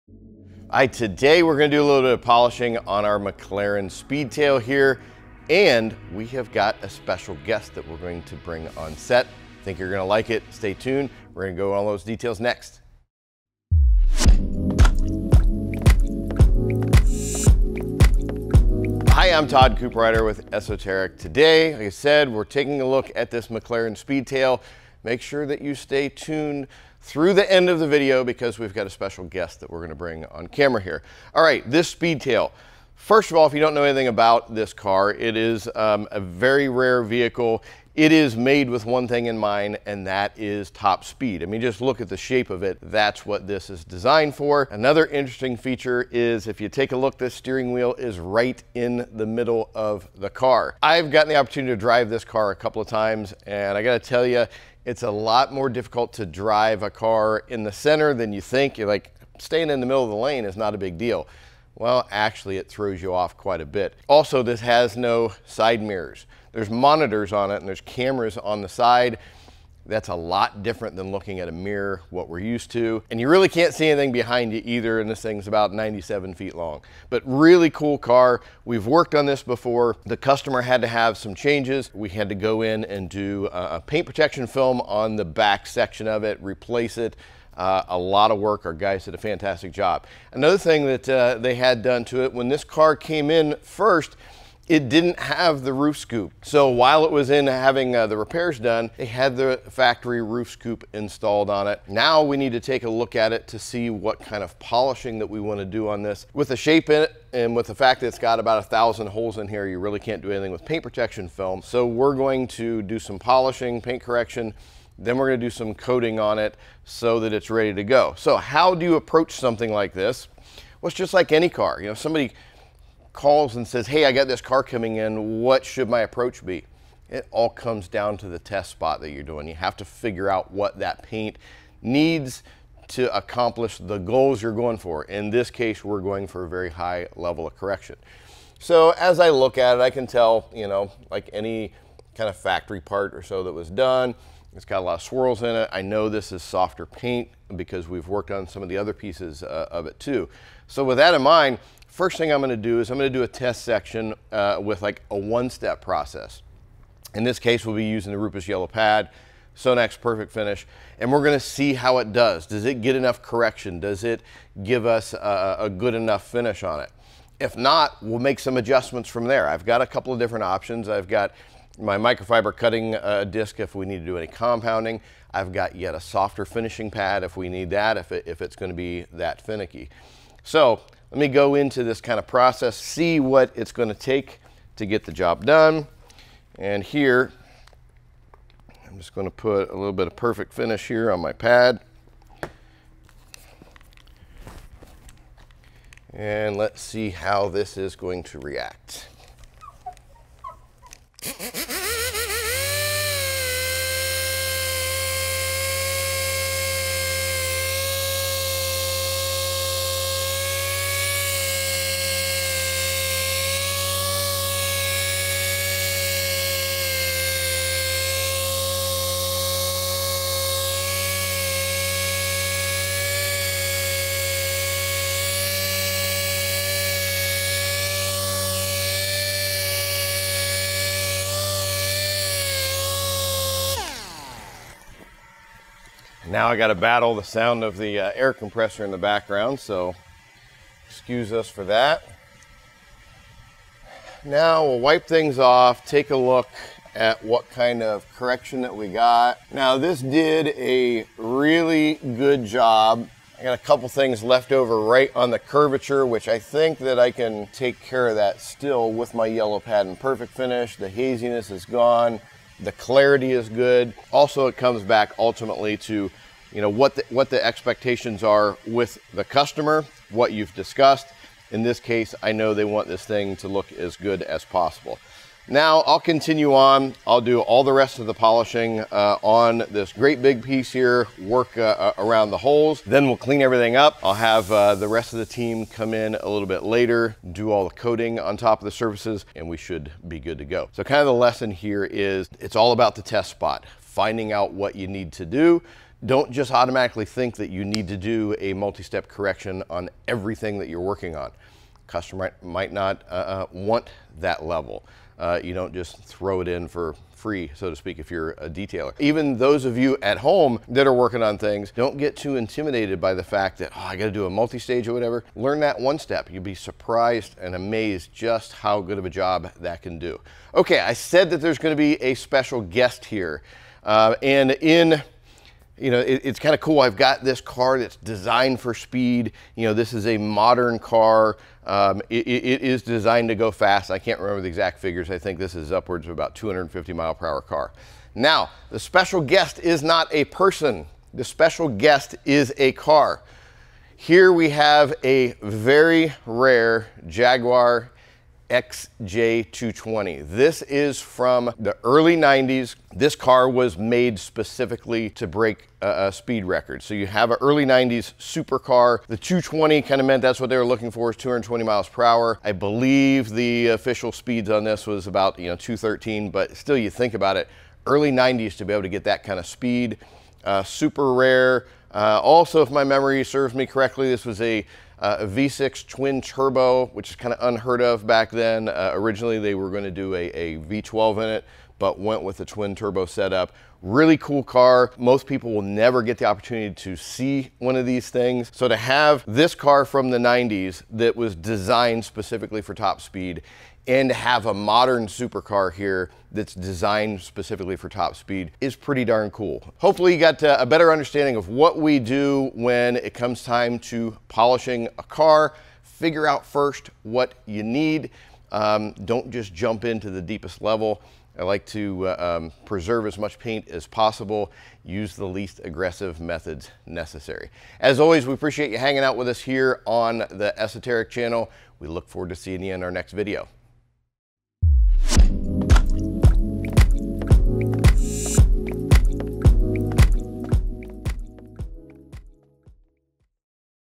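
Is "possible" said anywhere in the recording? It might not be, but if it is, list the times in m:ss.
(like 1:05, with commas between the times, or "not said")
4:34, 6:53.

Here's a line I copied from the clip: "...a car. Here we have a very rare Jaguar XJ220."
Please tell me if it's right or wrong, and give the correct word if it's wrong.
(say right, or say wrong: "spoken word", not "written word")
right.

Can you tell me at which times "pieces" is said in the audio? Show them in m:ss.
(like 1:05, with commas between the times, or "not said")
2:28, 4:40.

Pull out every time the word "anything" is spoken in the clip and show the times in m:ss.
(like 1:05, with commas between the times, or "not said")
0:33, 1:13, 1:50.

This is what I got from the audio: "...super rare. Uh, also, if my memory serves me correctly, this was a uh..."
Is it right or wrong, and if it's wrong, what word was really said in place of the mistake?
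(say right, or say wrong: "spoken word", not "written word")
right.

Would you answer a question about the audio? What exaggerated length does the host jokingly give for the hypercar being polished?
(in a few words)
97 feet.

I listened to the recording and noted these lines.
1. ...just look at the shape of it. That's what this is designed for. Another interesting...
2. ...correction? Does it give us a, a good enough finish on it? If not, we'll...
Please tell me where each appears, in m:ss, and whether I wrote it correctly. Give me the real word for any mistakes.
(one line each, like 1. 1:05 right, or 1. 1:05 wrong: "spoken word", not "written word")
1. 0:41 right
2. 2:43 right.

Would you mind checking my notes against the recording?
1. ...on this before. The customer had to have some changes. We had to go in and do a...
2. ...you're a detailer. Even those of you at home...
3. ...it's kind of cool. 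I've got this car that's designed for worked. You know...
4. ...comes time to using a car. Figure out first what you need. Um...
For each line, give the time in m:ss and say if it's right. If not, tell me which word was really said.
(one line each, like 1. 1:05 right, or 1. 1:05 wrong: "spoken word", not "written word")
1. 1:19 right
2. 5:08 right
3. 5:26 wrong: "speed", not "worked"
4. 6:43 wrong: "polishing", not "using".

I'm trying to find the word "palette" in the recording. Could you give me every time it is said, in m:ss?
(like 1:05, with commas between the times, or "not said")
not said.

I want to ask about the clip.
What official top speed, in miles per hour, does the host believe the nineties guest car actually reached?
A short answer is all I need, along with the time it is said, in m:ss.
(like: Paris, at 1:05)
213, at 6:05.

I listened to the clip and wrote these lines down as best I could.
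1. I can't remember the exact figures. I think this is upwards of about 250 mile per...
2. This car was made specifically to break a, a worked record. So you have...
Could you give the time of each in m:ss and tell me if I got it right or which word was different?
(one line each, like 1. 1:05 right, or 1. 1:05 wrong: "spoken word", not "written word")
1. 5:33 right
2. 5:52 wrong: "speed", not "worked".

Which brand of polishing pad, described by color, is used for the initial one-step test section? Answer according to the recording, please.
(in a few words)
Rupes Yellow Pad.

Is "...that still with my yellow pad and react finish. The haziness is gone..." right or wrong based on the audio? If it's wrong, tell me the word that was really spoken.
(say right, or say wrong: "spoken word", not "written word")
wrong: "perfect", not "react".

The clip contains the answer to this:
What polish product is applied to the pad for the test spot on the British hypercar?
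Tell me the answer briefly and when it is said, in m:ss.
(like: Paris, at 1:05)
Sonax Perfect Finish, at 2:39.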